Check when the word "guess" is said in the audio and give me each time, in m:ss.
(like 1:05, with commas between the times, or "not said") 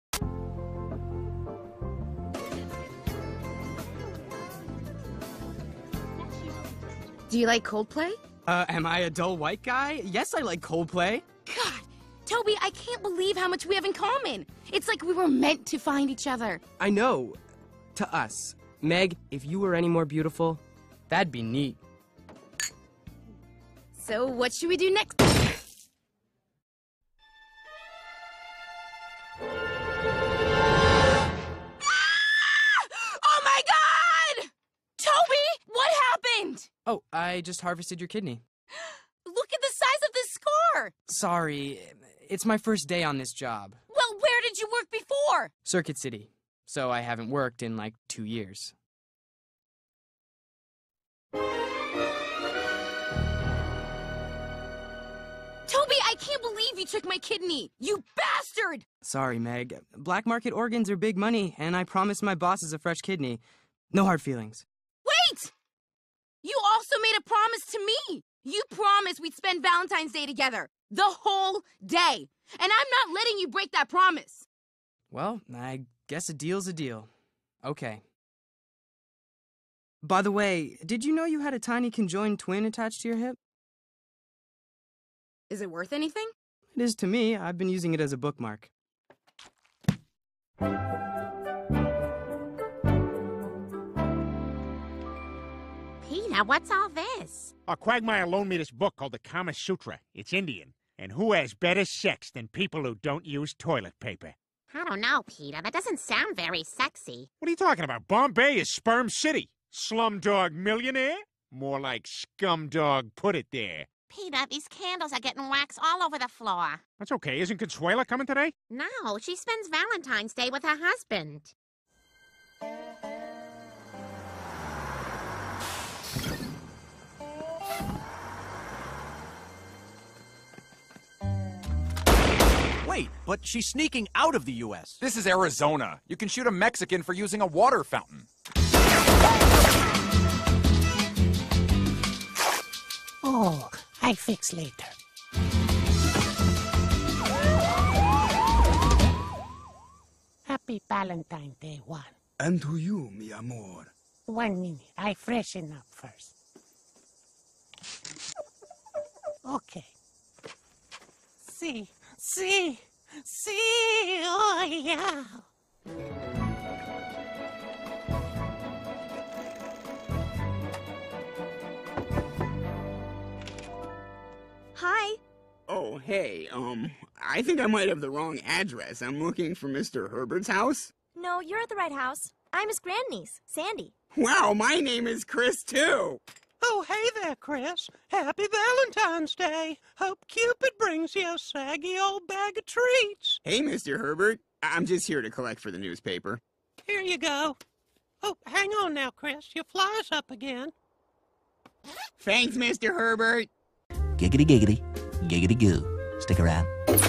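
1:16.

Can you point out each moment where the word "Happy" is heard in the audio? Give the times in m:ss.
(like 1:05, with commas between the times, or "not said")
2:30, 3:08.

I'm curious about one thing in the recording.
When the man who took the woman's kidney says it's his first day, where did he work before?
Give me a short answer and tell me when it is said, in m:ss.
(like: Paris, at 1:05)
Circuit City, at 0:45.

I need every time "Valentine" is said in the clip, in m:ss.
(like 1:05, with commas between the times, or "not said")
1:09, 1:59, 2:30, 3:08.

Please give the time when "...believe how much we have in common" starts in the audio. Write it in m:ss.
0:13.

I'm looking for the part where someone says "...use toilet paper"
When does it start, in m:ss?
1:43.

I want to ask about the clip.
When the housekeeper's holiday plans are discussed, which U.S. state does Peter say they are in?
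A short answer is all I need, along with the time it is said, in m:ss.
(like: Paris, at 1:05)
Arizona, at 2:15.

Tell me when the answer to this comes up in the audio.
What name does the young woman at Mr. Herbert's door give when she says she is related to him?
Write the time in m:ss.
3:03.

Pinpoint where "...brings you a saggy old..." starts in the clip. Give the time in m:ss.
3:10.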